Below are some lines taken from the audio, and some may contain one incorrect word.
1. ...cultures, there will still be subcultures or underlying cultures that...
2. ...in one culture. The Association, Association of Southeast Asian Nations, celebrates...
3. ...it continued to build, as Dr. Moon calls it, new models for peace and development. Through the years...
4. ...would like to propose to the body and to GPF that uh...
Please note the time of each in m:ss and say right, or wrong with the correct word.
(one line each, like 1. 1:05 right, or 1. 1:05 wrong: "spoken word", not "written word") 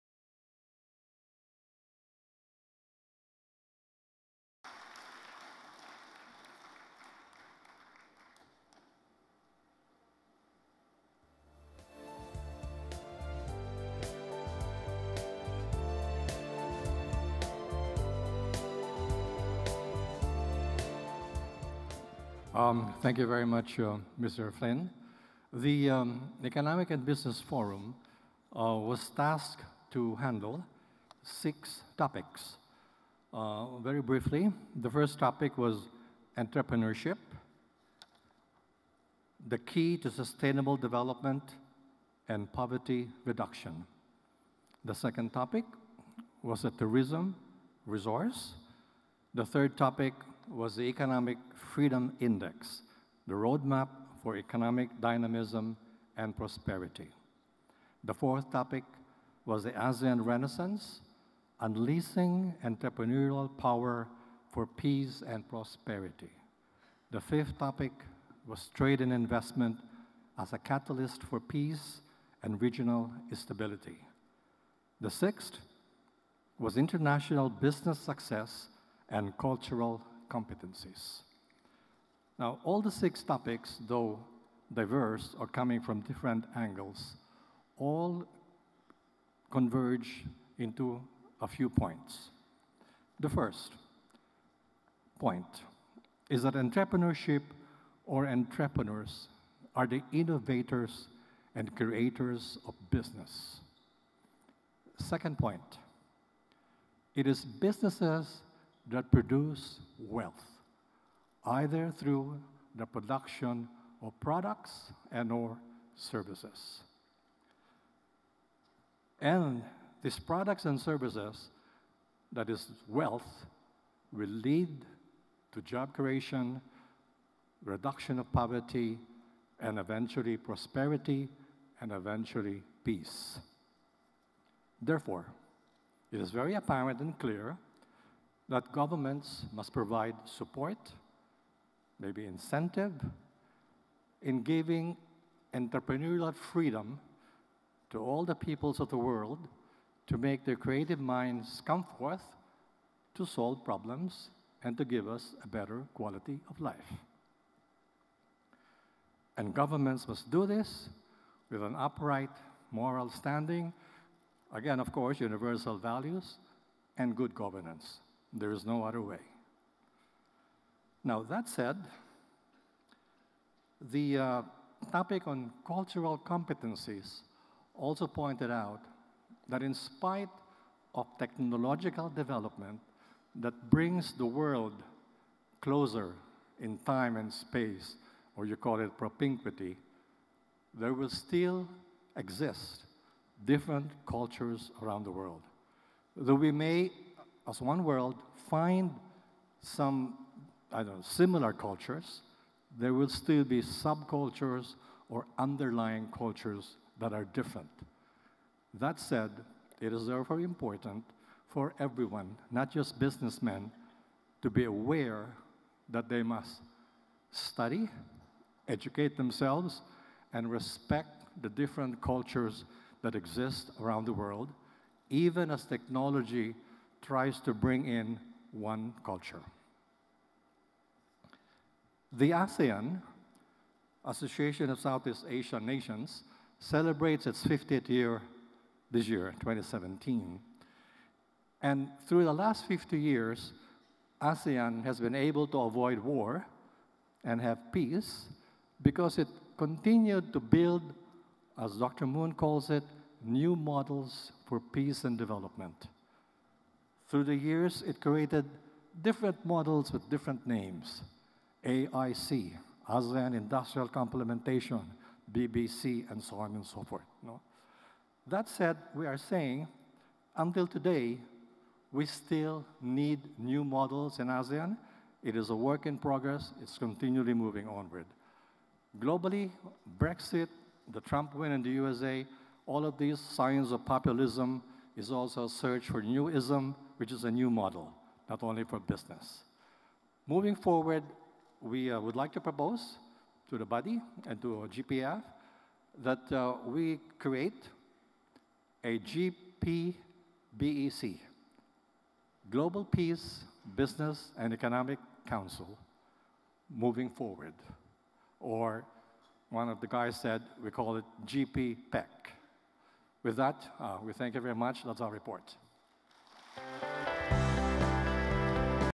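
1. 3:21 right
2. 3:47 wrong: "ASEAN", not "Association"
3. 4:09 right
4. 4:51 right.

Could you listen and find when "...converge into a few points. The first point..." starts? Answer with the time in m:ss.
1:29.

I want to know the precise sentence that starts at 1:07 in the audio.
The fifth topic was trade and investment as a catalyst for peace and regional stability.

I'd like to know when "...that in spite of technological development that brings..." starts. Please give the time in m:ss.
2:59.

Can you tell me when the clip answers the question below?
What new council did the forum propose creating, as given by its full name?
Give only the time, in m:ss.
5:02.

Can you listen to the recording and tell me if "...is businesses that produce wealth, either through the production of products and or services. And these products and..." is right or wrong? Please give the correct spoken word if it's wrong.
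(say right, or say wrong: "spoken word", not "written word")
right.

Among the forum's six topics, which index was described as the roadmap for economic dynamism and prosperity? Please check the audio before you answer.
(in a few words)
Economic Freedom Index.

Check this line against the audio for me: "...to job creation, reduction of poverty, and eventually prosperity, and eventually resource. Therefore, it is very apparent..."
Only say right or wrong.
wrong.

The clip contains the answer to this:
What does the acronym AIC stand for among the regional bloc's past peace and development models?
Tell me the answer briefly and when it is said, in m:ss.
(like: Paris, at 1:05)
ASEAN Industrial Complementation, at 4:22.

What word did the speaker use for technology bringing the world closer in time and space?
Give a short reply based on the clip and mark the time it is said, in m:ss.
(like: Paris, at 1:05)
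propinquity, at 3:08.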